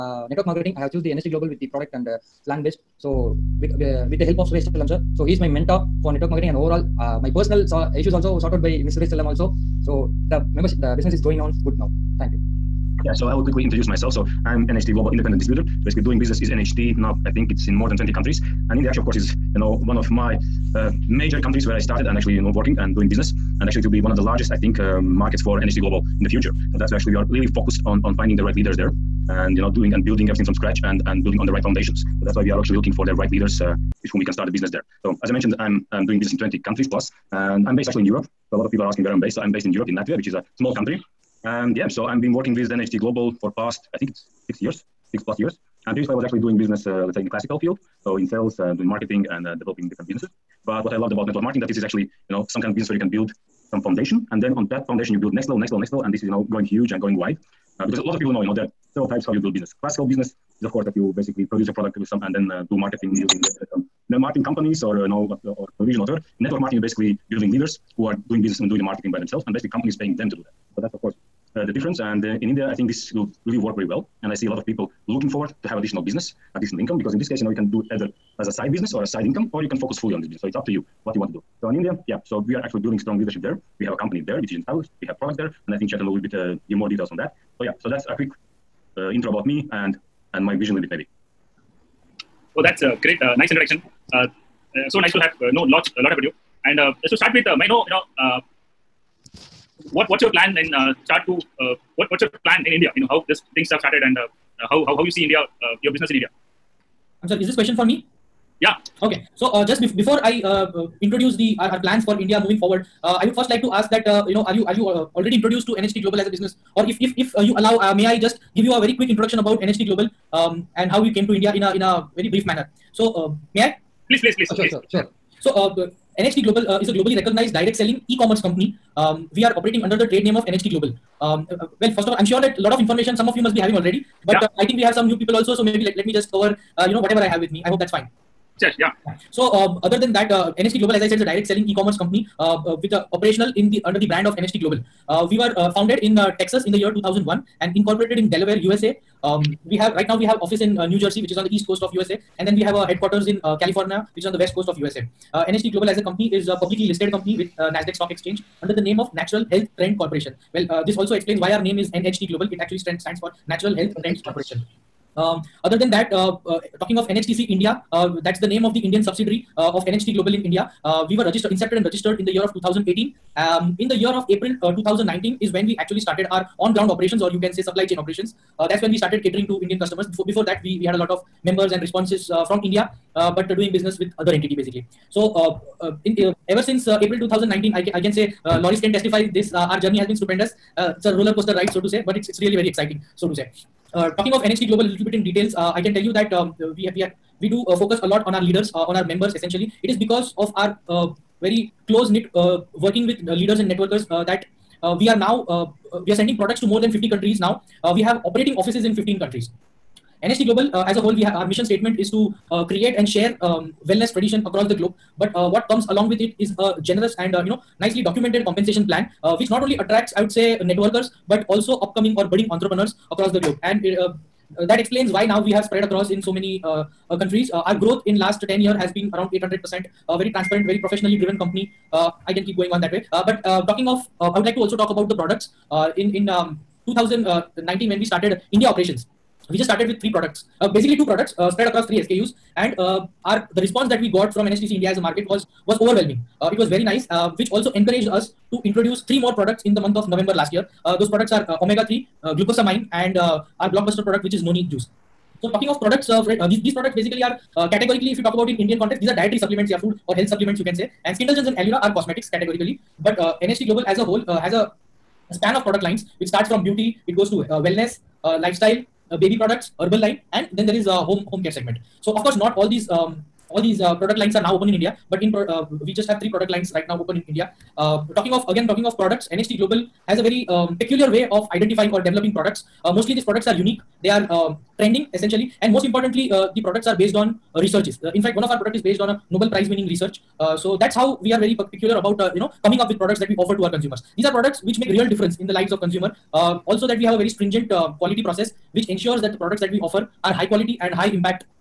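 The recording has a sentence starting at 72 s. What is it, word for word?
And uh, in India, I think this will really work very well.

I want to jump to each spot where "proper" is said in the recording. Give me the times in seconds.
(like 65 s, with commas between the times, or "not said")
not said.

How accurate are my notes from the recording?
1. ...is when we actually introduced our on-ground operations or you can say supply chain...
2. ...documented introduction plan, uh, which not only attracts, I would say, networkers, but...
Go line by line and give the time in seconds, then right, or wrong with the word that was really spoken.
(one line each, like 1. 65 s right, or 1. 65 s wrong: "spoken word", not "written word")
1. 175 s wrong: "started", not "introduced"
2. 218 s wrong: "compensation", not "introduction".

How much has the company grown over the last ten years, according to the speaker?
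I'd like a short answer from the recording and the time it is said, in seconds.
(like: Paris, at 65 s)
800%, at 229 s.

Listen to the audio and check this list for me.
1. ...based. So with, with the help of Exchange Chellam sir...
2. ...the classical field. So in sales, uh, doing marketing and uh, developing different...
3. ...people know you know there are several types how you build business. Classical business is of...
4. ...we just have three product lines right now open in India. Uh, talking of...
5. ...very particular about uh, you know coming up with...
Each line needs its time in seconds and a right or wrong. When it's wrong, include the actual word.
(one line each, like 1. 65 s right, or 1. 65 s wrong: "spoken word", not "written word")
1. 2 s wrong: "Suresh", not "Exchange"
2. 47 s right
3. 58 s right
4. 275 s right
5. 291 s right.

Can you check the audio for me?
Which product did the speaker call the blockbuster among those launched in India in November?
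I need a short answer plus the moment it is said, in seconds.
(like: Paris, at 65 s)
noni juice, at 254 s.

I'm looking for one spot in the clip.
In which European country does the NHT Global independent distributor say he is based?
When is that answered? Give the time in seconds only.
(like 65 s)
39 s.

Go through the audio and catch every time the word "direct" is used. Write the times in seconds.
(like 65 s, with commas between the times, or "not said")
127 s, 141 s.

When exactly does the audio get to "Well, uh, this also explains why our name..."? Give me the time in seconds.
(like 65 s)
160 s.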